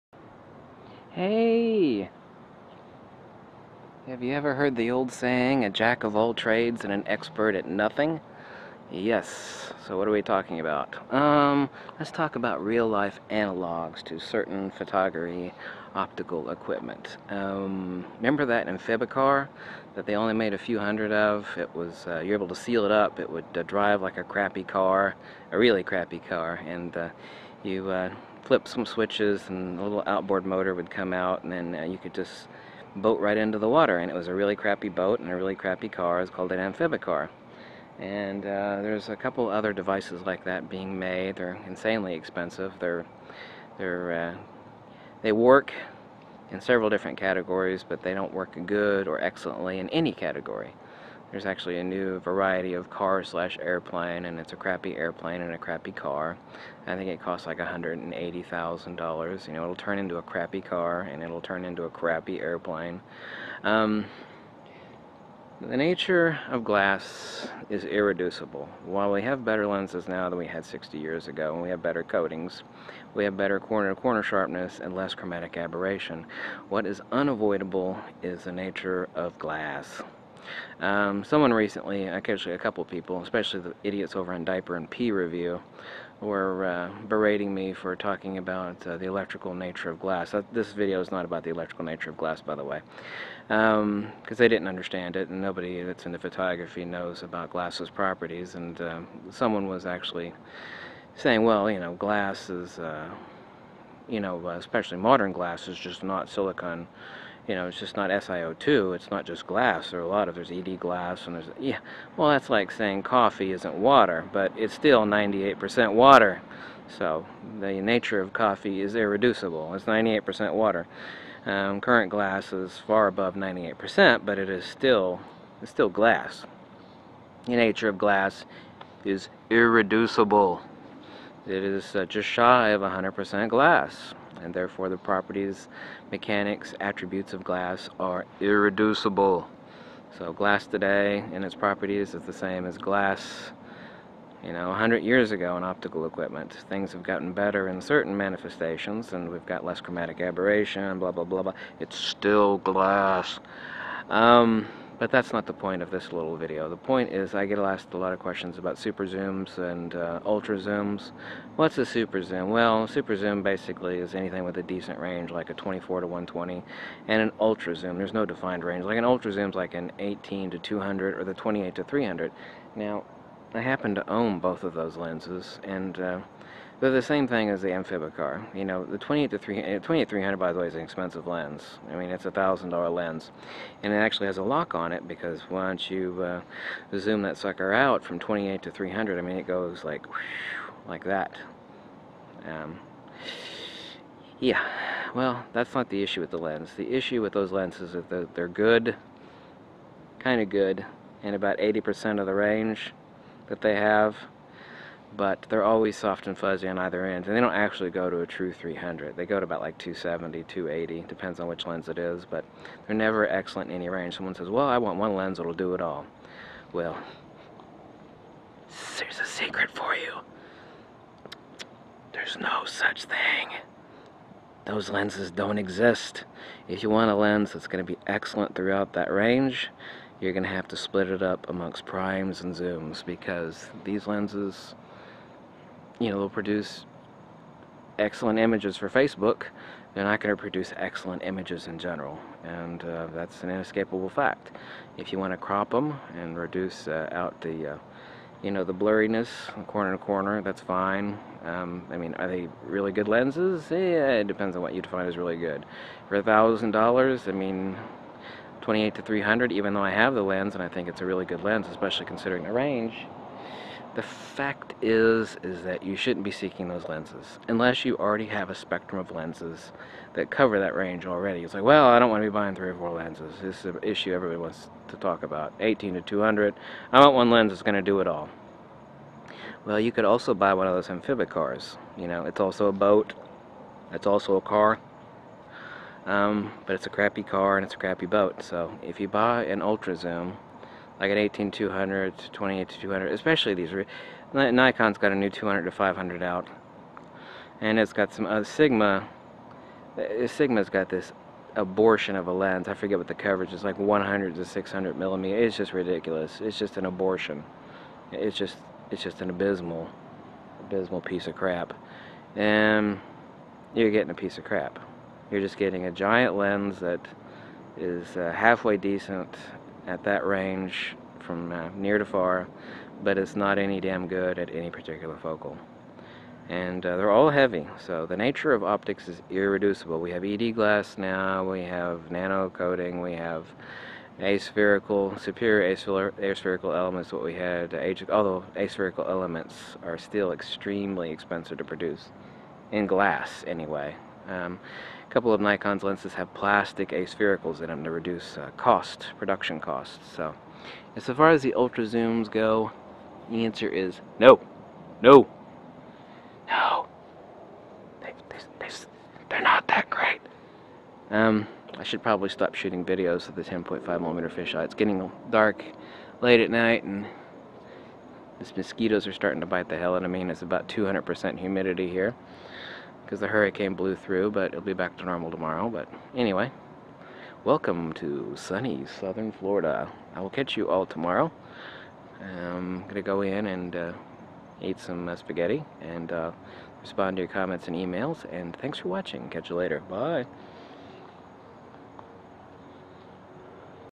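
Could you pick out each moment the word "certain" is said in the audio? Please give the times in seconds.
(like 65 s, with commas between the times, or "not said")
14 s, 147 s.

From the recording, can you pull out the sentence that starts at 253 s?
Yeah, it depends on what you define as really good.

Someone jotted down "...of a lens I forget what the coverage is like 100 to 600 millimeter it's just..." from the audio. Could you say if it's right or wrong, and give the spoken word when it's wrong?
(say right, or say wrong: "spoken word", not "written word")
right.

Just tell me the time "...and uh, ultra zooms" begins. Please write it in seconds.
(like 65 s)
159 s.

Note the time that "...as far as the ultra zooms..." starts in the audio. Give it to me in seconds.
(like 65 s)
350 s.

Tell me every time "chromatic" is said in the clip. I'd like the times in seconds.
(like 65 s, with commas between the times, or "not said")
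75 s, 149 s.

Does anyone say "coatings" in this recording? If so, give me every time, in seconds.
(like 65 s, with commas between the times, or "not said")
72 s, 332 s.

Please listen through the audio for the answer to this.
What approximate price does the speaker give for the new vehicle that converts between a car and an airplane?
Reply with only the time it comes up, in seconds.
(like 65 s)
57 s.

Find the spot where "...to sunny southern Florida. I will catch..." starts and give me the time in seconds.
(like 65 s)
377 s.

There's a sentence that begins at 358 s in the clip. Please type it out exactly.
They, they, they, are not that great.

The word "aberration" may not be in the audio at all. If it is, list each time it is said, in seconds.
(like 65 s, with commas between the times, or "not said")
75 s, 150 s.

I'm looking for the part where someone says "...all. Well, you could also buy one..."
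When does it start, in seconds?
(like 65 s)
278 s.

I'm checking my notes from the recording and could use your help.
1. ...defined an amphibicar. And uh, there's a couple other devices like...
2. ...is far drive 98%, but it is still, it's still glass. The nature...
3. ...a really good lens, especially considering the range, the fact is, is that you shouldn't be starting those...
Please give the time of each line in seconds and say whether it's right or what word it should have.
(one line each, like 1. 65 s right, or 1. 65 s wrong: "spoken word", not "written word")
1. 36 s wrong: "called", not "defined"
2. 122 s wrong: "above", not "drive"
3. 261 s wrong: "seeking", not "starting".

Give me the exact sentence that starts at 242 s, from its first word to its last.
And uh, that's an inescapable fact.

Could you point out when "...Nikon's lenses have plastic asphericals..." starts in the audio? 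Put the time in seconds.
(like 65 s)
345 s.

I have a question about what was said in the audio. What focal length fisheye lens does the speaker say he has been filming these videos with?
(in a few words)
10.5 millimeter.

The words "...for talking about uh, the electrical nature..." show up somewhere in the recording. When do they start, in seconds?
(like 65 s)
87 s.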